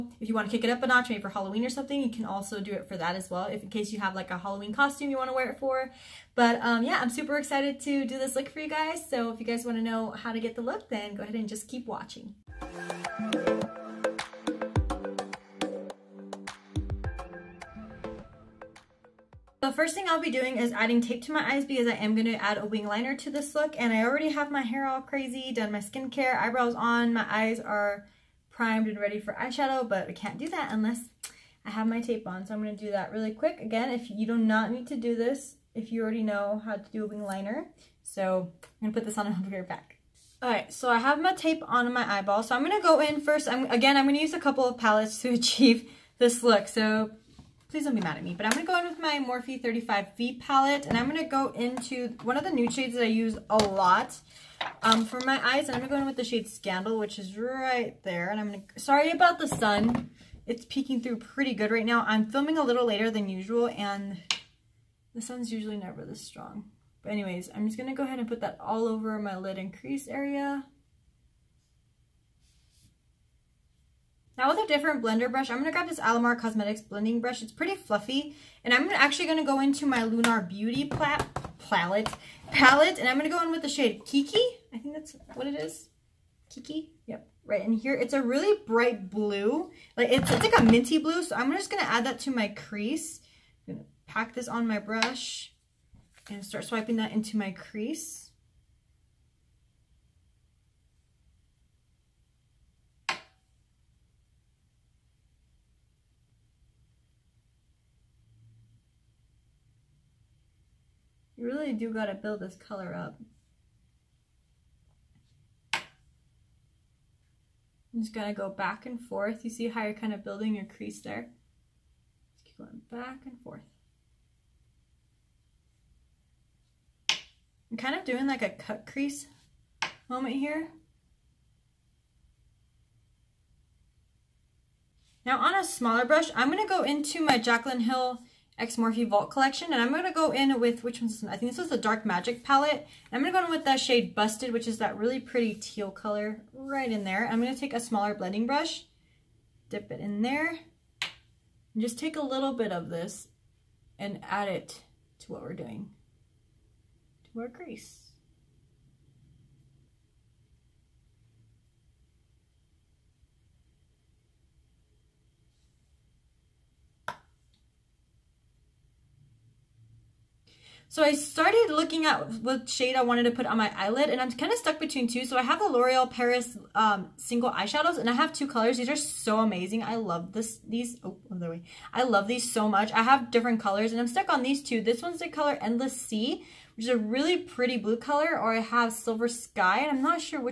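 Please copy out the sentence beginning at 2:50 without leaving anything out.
So I started looking at what shade I wanted to put on my eyelid and I'm kind of stuck between two.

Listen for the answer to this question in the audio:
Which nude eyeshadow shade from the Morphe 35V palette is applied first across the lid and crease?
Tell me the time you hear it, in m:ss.
0:56.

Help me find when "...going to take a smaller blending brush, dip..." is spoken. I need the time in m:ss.
2:27.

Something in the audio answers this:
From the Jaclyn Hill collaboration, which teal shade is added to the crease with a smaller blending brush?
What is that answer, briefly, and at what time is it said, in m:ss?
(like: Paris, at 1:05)
Busted, at 2:24.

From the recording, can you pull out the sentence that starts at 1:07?
But anyways, I'm just going to go ahead and put that all over my lid and crease area.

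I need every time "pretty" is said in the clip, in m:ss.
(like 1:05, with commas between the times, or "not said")
1:01, 1:17, 2:25, 3:07.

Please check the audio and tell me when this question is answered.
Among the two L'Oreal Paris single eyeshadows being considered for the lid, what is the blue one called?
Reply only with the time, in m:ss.
3:05.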